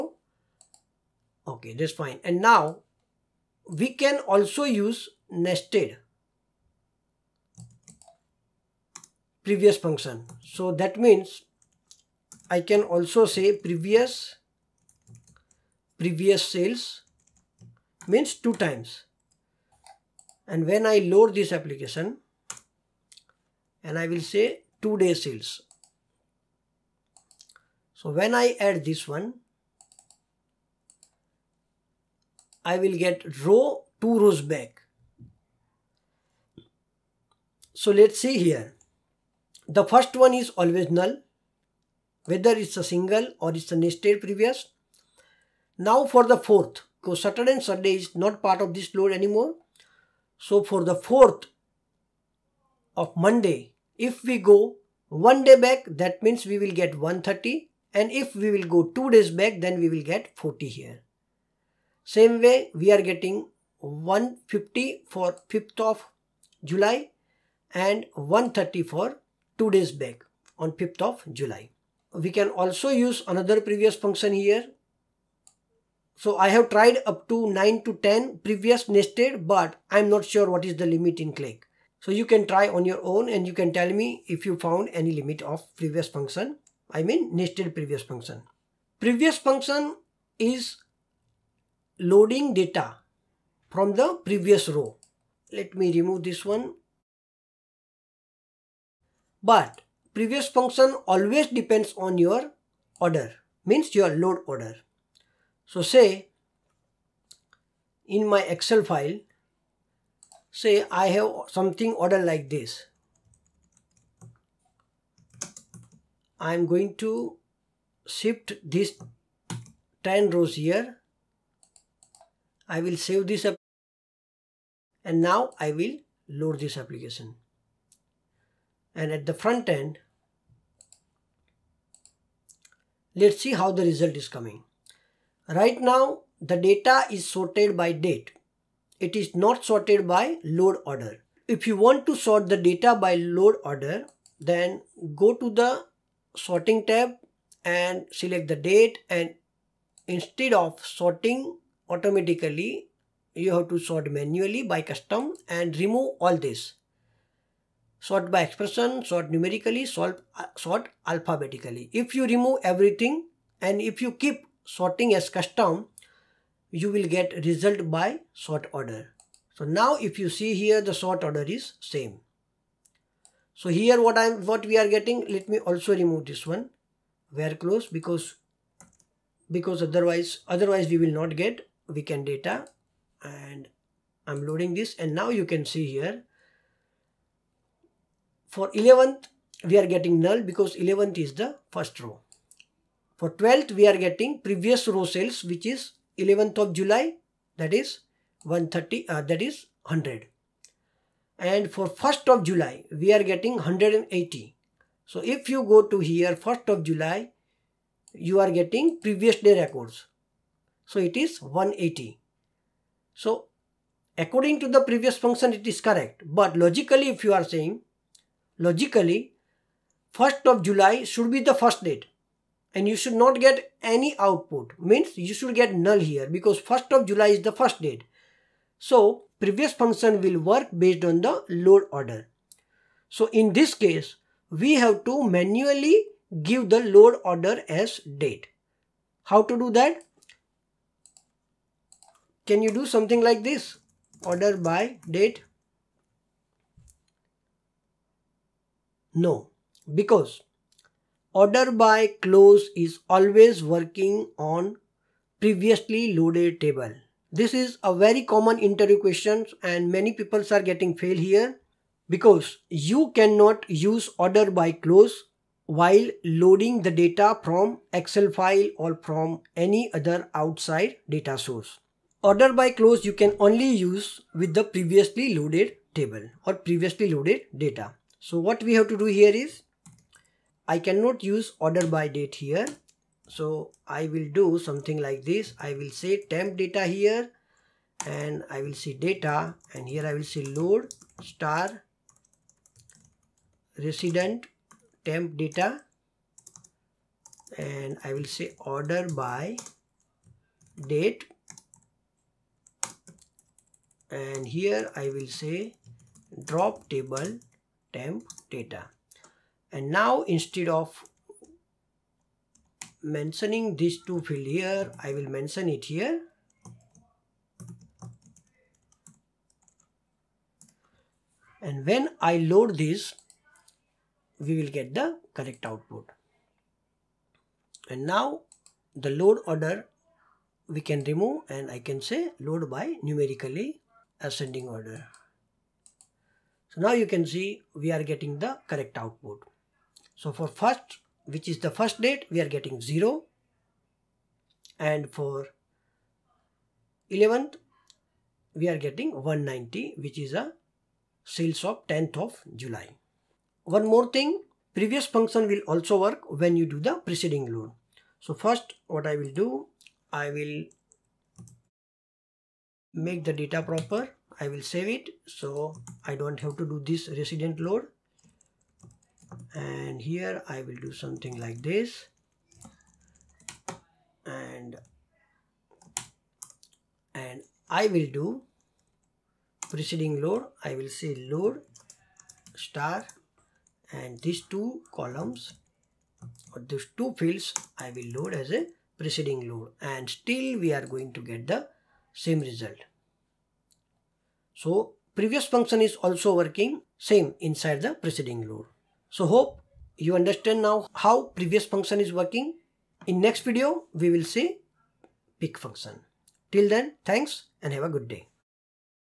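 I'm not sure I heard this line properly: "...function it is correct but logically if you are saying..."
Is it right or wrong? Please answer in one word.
right.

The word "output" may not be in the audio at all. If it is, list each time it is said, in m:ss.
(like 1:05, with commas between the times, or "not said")
3:44, 5:25, 5:38.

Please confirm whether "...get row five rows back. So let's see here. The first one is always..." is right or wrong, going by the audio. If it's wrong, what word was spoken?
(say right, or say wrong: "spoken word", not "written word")
wrong: "two", not "five".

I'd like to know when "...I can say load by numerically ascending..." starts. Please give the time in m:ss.
5:31.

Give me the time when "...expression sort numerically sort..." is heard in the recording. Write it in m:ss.
2:38.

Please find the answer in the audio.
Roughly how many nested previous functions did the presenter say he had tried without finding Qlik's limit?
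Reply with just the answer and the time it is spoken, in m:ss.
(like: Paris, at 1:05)
9 to 10, at 1:17.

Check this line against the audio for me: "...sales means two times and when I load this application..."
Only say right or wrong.
right.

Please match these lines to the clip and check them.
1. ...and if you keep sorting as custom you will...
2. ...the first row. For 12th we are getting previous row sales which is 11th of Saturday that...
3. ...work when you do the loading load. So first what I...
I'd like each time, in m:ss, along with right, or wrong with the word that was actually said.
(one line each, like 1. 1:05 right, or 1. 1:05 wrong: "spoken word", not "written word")
1. 2:43 right
2. 3:11 wrong: "July", not "Saturday"
3. 5:55 wrong: "preceding", not "loading".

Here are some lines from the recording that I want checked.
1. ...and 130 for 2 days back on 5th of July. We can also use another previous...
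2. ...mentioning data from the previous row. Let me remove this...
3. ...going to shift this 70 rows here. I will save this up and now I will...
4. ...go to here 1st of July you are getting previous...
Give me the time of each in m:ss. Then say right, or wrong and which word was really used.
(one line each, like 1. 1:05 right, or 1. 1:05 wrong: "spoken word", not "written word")
1. 1:07 right
2. 1:31 wrong: "loading", not "mentioning"
3. 1:56 wrong: "10", not "70"
4. 3:25 right.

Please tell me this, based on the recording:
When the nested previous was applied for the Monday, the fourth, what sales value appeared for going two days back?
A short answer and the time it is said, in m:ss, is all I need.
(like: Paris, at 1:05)
40, at 1:00.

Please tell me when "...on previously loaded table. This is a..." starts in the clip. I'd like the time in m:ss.
4:14.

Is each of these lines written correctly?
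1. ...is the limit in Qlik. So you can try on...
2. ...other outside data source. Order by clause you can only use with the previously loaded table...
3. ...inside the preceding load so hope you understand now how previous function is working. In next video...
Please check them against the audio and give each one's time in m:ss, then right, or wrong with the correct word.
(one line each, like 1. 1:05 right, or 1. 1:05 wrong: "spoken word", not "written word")
1. 1:20 right
2. 4:29 right
3. 6:37 right.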